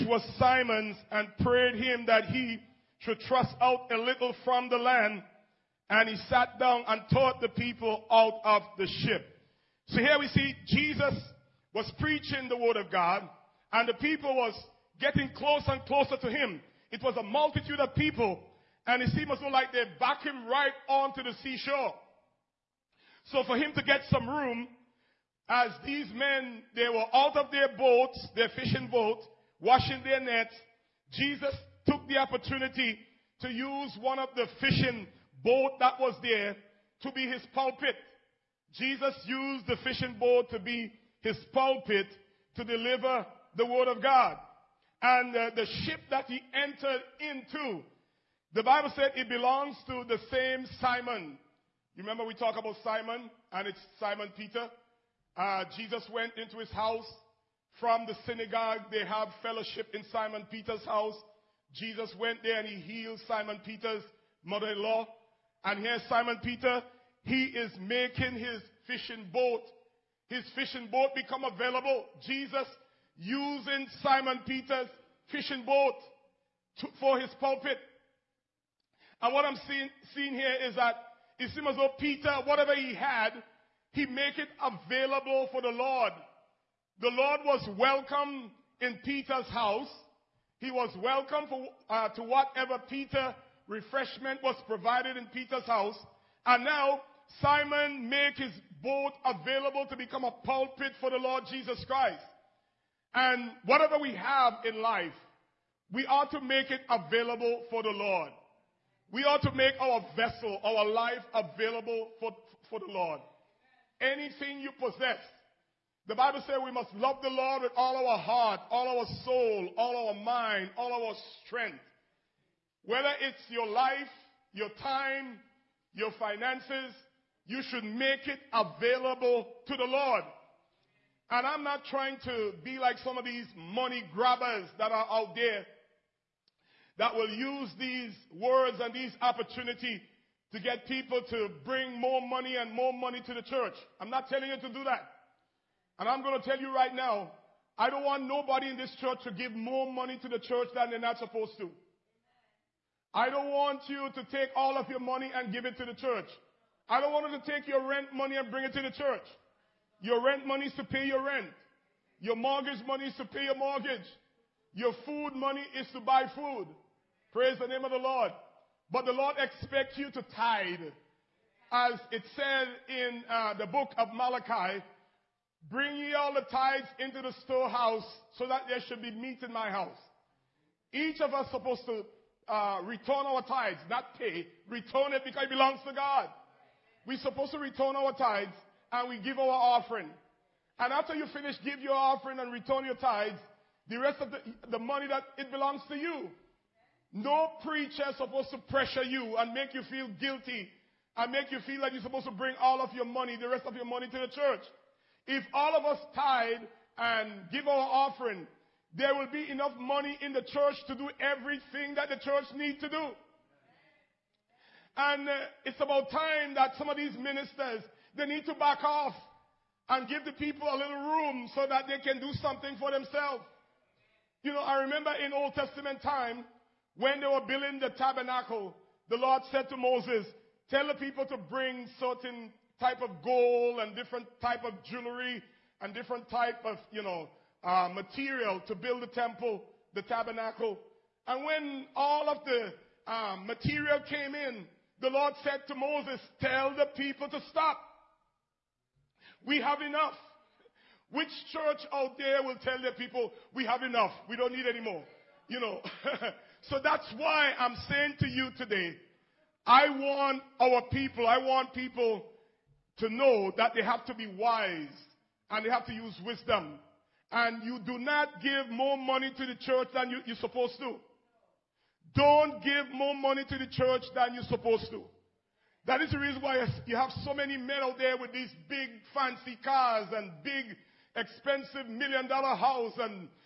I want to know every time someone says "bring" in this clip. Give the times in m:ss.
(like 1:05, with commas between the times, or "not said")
2:21, 2:38, 2:55, 3:22, 3:51.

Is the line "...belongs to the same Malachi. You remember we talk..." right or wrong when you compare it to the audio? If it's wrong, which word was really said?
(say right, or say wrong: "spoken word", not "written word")
wrong: "Simon", not "Malachi".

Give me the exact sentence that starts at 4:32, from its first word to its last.
Don't give more money to the church than you're supposed to.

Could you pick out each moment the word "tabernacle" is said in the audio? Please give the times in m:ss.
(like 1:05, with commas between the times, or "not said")
3:47, 4:00.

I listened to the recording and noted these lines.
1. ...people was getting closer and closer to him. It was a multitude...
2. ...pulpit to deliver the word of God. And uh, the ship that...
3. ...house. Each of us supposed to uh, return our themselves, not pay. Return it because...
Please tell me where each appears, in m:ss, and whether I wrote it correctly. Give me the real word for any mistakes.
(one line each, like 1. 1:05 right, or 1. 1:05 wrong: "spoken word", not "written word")
1. 0:13 right
2. 0:41 right
3. 2:59 wrong: "tithes", not "themselves".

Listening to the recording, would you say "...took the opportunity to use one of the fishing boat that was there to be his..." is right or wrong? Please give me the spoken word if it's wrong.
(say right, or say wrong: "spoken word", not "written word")
right.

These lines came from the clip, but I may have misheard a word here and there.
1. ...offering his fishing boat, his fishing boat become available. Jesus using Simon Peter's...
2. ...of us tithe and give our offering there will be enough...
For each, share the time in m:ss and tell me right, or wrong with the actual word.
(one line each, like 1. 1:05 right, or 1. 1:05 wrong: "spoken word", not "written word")
1. 1:07 wrong: "making", not "offering"
2. 3:25 right.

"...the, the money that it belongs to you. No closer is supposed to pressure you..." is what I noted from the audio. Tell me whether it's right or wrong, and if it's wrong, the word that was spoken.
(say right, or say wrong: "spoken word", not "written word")
wrong: "preacher", not "closer".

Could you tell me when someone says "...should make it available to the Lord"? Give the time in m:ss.
2:07.